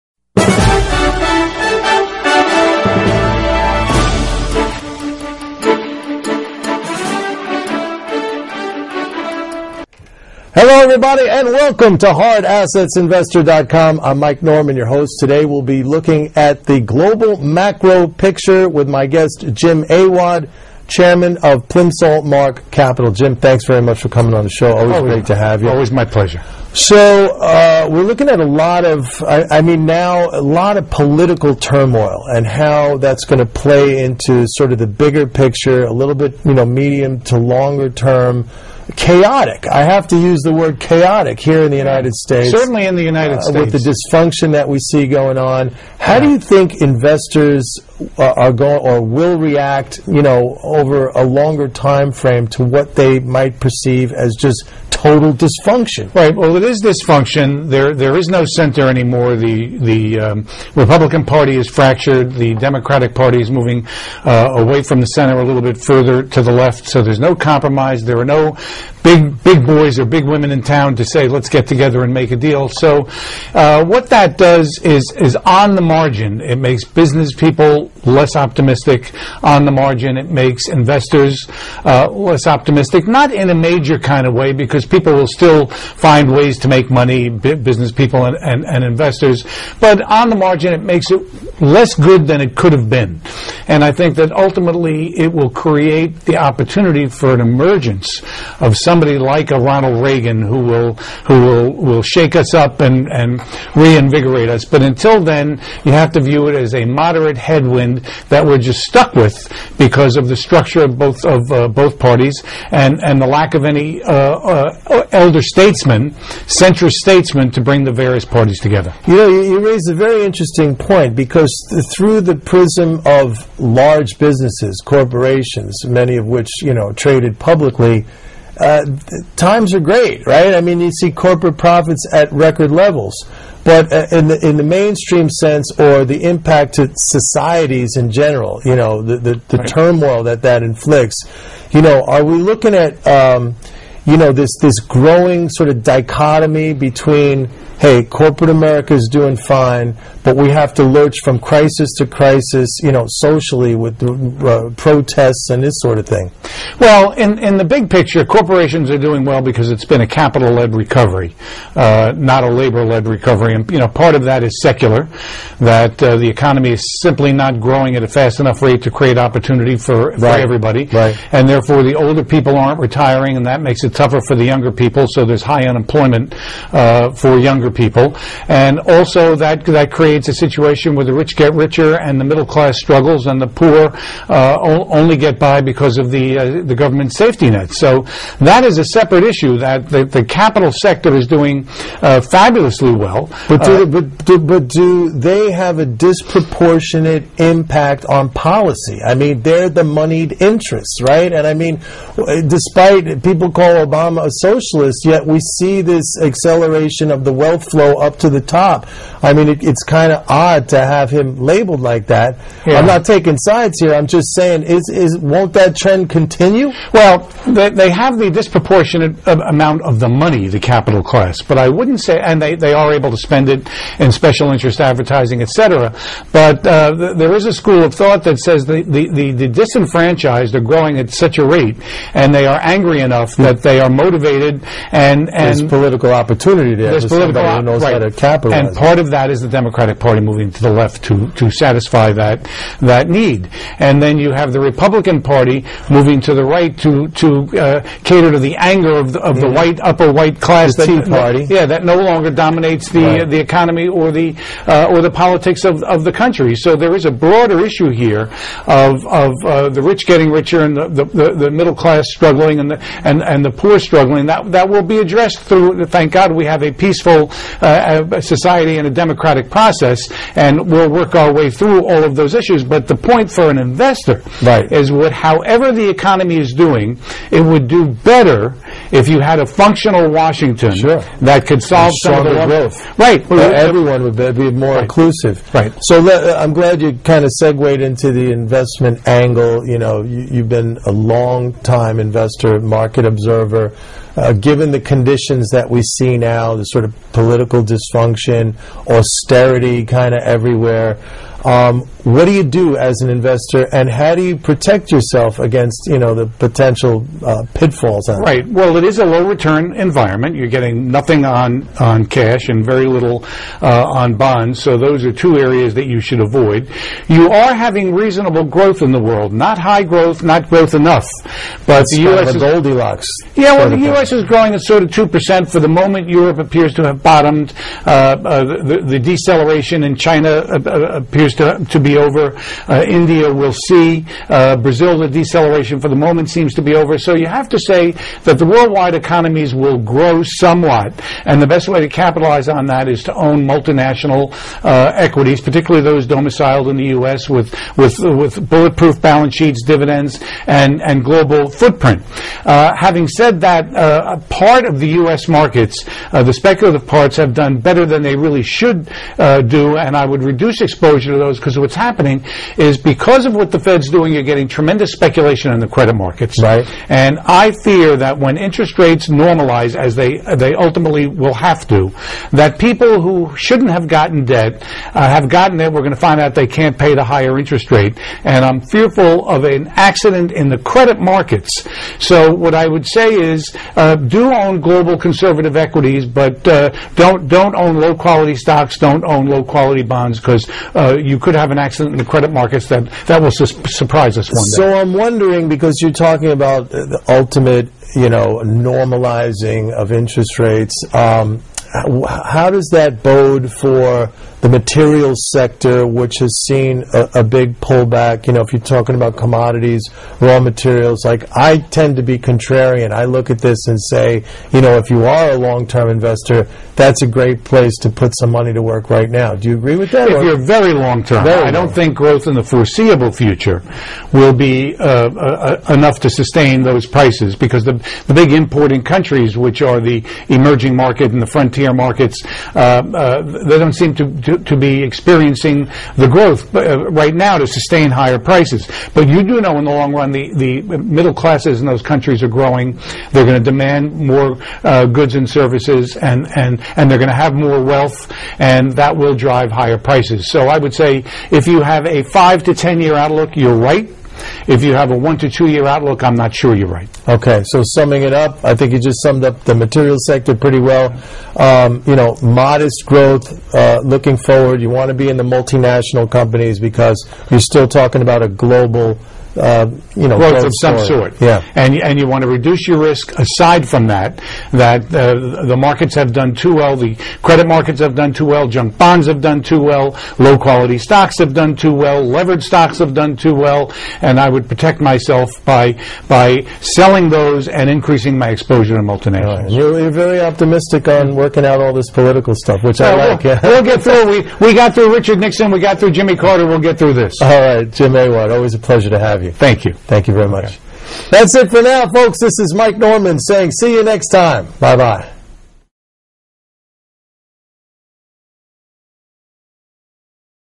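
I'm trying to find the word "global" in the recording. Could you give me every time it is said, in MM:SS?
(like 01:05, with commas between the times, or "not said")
00:16, 05:51, 06:24, 07:48.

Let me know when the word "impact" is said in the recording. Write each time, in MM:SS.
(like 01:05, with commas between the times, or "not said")
02:16, 03:17.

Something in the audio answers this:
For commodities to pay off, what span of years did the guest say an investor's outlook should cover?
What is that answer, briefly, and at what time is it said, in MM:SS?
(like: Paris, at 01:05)
5 to 10 years, at 07:32.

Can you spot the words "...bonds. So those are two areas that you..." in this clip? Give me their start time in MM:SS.
05:14.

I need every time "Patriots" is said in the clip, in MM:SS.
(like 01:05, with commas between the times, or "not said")
not said.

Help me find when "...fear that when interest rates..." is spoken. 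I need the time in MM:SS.
06:07.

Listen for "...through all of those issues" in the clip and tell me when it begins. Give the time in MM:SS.
04:31.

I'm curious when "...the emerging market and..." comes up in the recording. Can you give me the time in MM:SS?
07:09.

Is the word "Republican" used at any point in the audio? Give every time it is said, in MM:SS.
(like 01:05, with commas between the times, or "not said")
01:00, 04:04.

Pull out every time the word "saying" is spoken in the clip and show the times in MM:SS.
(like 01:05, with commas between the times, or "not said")
03:34, 08:23.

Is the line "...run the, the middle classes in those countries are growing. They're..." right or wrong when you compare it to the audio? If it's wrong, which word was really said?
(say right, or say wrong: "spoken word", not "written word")
right.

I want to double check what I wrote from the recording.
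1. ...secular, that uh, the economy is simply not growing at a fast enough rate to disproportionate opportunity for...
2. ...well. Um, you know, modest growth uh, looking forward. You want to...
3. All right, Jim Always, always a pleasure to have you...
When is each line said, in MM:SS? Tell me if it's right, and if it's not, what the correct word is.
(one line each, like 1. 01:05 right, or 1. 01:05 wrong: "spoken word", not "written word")
1. 02:44 wrong: "create", not "disproportionate"
2. 07:40 right
3. 08:17 wrong: "Awad", not "Always".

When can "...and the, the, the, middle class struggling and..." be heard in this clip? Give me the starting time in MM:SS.
04:20.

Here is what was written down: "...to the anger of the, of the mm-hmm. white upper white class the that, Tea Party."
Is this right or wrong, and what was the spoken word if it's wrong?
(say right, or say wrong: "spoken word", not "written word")
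right.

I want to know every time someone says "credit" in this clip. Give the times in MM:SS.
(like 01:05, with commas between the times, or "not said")
06:05, 06:20, 06:32, 07:57.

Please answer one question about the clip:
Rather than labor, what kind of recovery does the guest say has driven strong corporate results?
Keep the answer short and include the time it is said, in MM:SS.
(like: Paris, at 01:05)
Capital led, at 02:40.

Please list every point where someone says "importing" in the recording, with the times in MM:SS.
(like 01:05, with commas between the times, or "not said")
07:08.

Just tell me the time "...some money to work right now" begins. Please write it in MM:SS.
06:58.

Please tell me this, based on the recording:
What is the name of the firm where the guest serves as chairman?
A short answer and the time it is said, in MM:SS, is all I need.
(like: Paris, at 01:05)
Plimsoll Mark Capital, at 00:21.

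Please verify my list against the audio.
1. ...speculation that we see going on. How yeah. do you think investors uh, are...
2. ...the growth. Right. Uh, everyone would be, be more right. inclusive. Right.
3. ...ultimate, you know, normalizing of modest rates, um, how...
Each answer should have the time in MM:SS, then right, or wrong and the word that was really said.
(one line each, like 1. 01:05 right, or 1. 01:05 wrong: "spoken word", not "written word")
1. 00:43 wrong: "dysfunction", not "speculation"
2. 04:42 right
3. 06:37 wrong: "interest", not "modest".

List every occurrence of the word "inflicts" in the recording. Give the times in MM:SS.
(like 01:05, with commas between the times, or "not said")
02:20.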